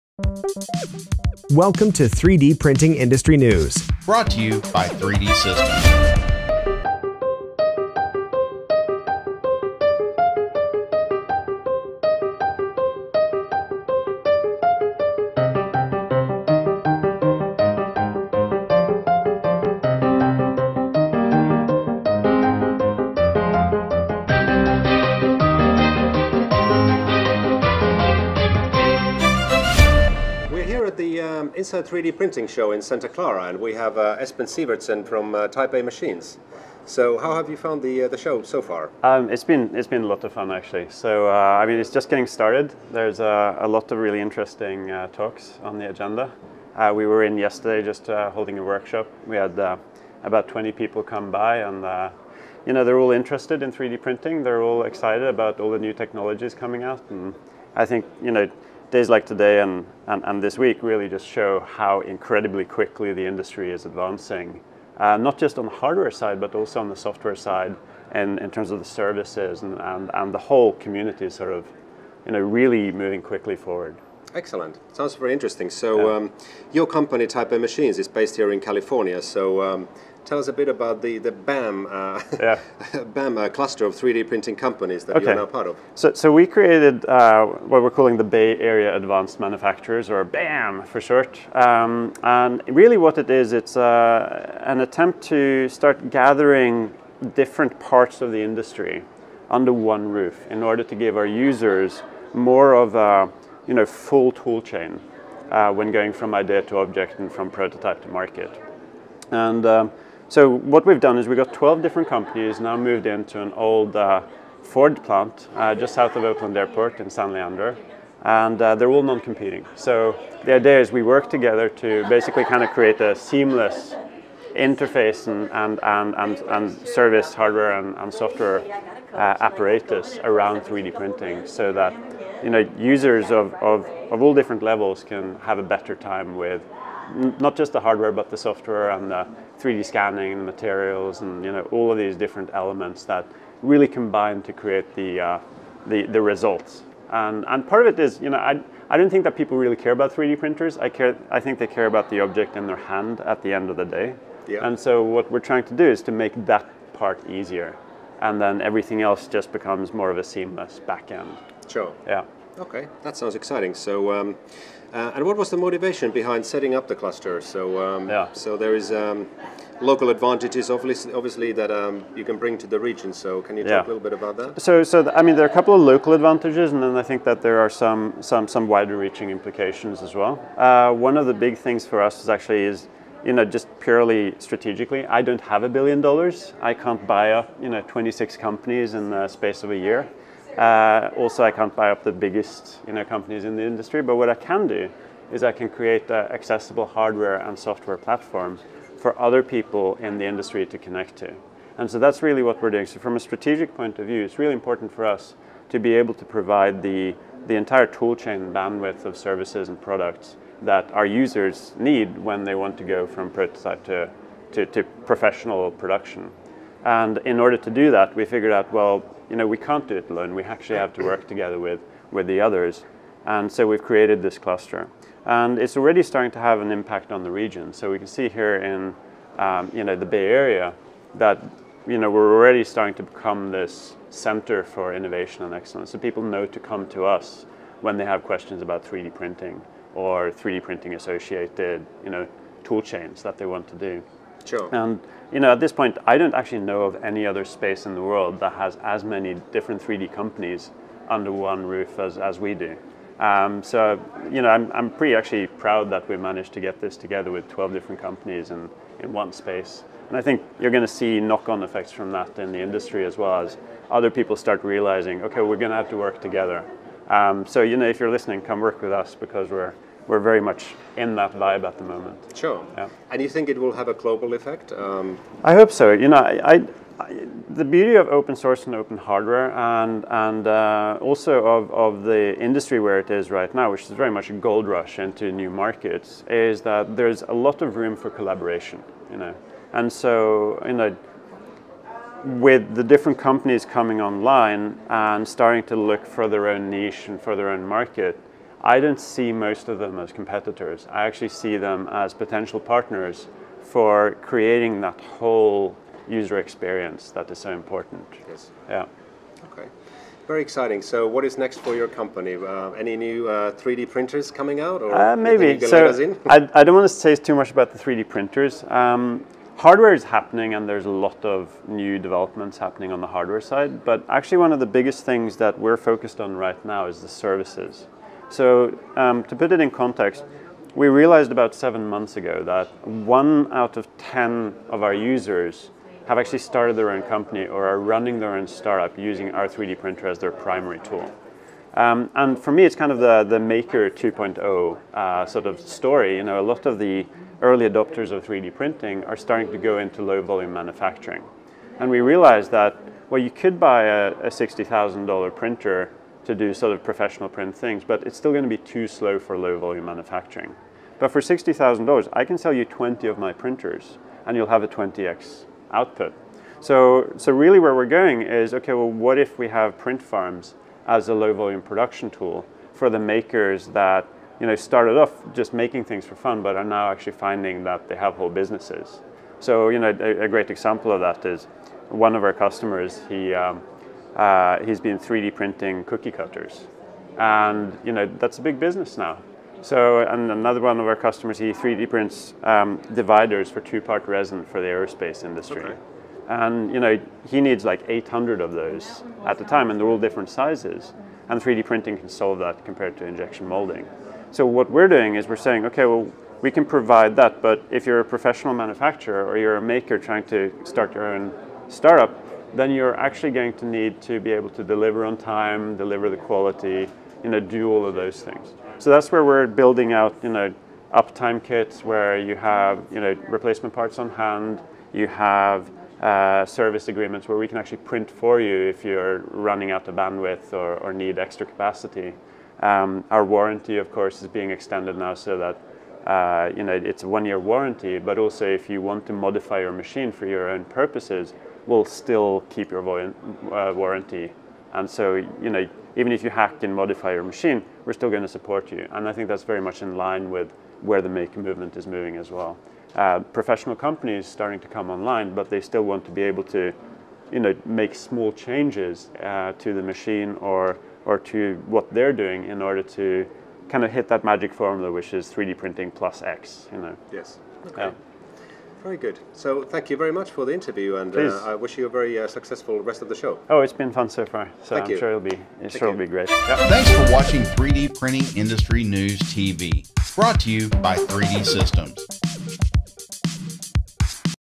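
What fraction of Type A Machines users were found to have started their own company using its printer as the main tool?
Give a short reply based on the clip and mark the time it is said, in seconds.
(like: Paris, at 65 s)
1 out of 10, at 332 s.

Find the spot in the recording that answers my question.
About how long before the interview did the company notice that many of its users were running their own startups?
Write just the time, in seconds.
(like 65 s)
331 s.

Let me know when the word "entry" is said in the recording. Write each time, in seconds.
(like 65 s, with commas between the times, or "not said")
not said.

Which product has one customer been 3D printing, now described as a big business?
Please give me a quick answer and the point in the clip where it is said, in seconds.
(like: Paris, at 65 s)
cookie cutters, at 385 s.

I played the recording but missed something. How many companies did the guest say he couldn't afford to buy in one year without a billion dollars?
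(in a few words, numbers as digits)
26.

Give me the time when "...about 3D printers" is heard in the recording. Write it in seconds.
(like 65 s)
149 s.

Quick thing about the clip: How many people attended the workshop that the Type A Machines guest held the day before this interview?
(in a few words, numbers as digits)
20.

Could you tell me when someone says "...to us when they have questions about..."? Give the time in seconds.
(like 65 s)
236 s.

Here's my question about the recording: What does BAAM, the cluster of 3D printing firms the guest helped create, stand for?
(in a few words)
Bay Area Advanced Manufacturers.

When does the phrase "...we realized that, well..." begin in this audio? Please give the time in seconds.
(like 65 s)
351 s.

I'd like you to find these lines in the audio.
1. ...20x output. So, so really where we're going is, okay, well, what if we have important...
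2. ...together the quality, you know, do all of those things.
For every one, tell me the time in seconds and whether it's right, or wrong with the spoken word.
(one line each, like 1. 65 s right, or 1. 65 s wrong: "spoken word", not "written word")
1. 364 s wrong: "print", not "important"
2. 415 s wrong: "deliver", not "together".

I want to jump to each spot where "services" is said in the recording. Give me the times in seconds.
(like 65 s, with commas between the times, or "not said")
68 s, 126 s, 209 s, 327 s, 426 s.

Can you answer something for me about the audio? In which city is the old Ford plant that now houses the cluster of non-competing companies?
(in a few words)
San Leandro.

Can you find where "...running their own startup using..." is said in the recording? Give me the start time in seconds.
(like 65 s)
337 s.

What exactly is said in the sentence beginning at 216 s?
And in order to do that, we figured out, well, you know, we can't do it alone.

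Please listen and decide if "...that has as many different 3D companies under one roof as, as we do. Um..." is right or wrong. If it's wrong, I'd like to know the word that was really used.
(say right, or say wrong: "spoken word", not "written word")
right.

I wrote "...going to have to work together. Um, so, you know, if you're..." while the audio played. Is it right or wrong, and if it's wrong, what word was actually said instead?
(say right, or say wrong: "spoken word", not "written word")
right.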